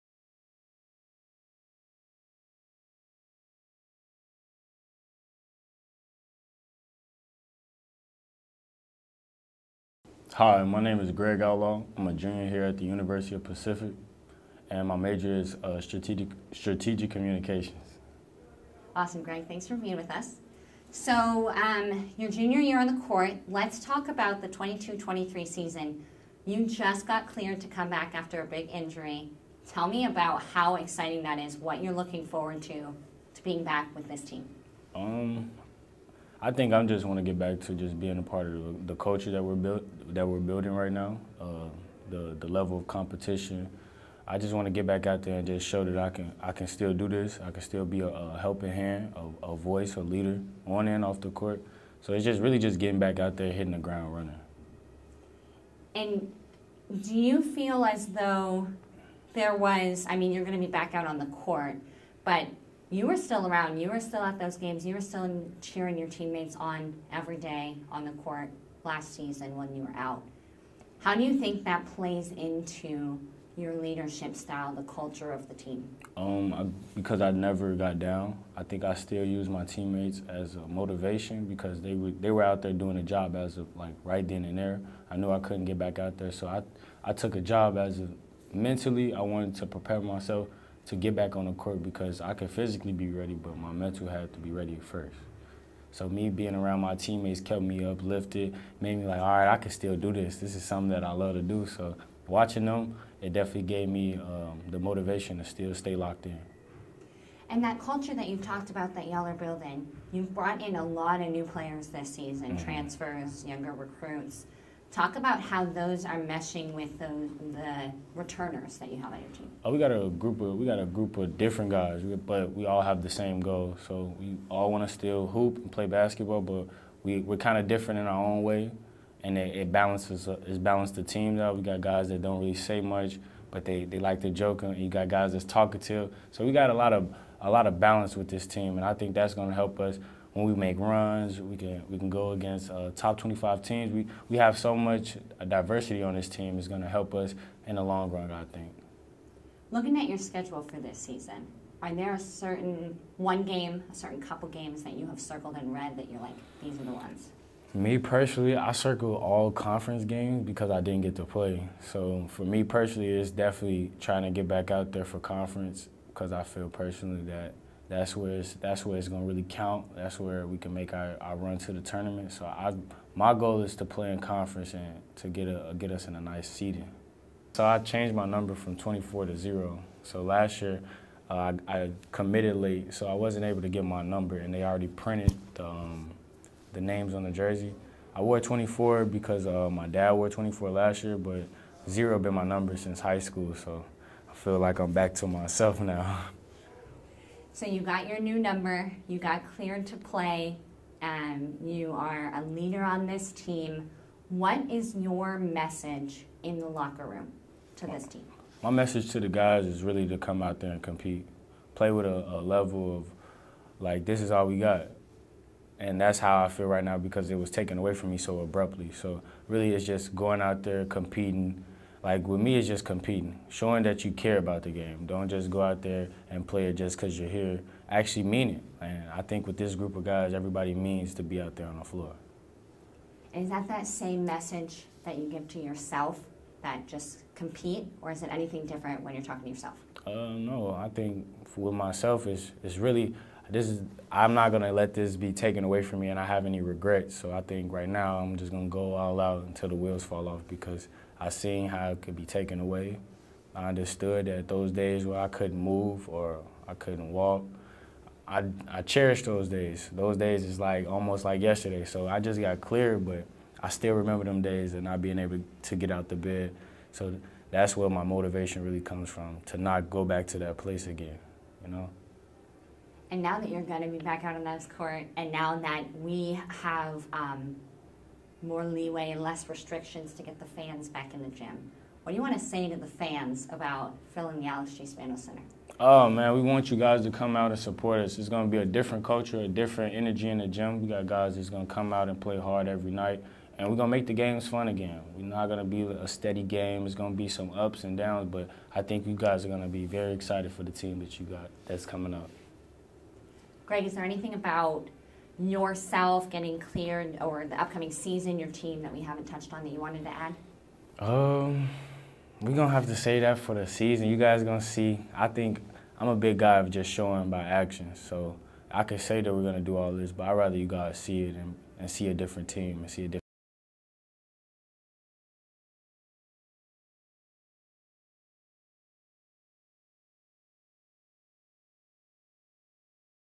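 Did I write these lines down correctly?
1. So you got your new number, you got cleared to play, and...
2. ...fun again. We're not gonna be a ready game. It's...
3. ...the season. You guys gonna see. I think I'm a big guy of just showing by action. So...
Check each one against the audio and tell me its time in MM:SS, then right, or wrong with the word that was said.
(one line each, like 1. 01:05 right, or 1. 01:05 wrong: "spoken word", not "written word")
1. 03:17 right
2. 04:54 wrong: "steady", not "ready"
3. 05:13 right.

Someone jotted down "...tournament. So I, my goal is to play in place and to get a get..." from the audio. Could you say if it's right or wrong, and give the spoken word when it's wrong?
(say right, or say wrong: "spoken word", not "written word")
wrong: "conference", not "place".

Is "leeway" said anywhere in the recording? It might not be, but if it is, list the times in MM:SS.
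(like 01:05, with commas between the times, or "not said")
04:38.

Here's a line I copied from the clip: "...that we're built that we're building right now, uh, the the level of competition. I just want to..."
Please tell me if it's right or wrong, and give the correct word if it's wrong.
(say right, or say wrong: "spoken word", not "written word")
right.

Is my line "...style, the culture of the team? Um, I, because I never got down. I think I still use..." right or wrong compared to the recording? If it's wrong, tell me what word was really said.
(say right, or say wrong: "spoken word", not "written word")
right.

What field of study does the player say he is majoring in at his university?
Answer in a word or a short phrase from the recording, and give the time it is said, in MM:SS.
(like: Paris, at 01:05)
strategic communications, at 00:16.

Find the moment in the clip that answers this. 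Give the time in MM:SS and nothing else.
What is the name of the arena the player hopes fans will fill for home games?
04:44.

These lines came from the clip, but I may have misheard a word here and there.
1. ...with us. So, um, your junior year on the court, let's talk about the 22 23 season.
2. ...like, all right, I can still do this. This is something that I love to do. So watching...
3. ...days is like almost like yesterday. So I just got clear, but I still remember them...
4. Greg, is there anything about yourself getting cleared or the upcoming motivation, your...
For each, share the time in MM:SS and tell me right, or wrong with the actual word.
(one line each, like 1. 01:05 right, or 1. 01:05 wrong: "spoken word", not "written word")
1. 00:19 right
2. 01:39 right
3. 04:20 right
4. 05:03 wrong: "season", not "motivation".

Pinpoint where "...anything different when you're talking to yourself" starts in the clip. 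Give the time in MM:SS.
03:58.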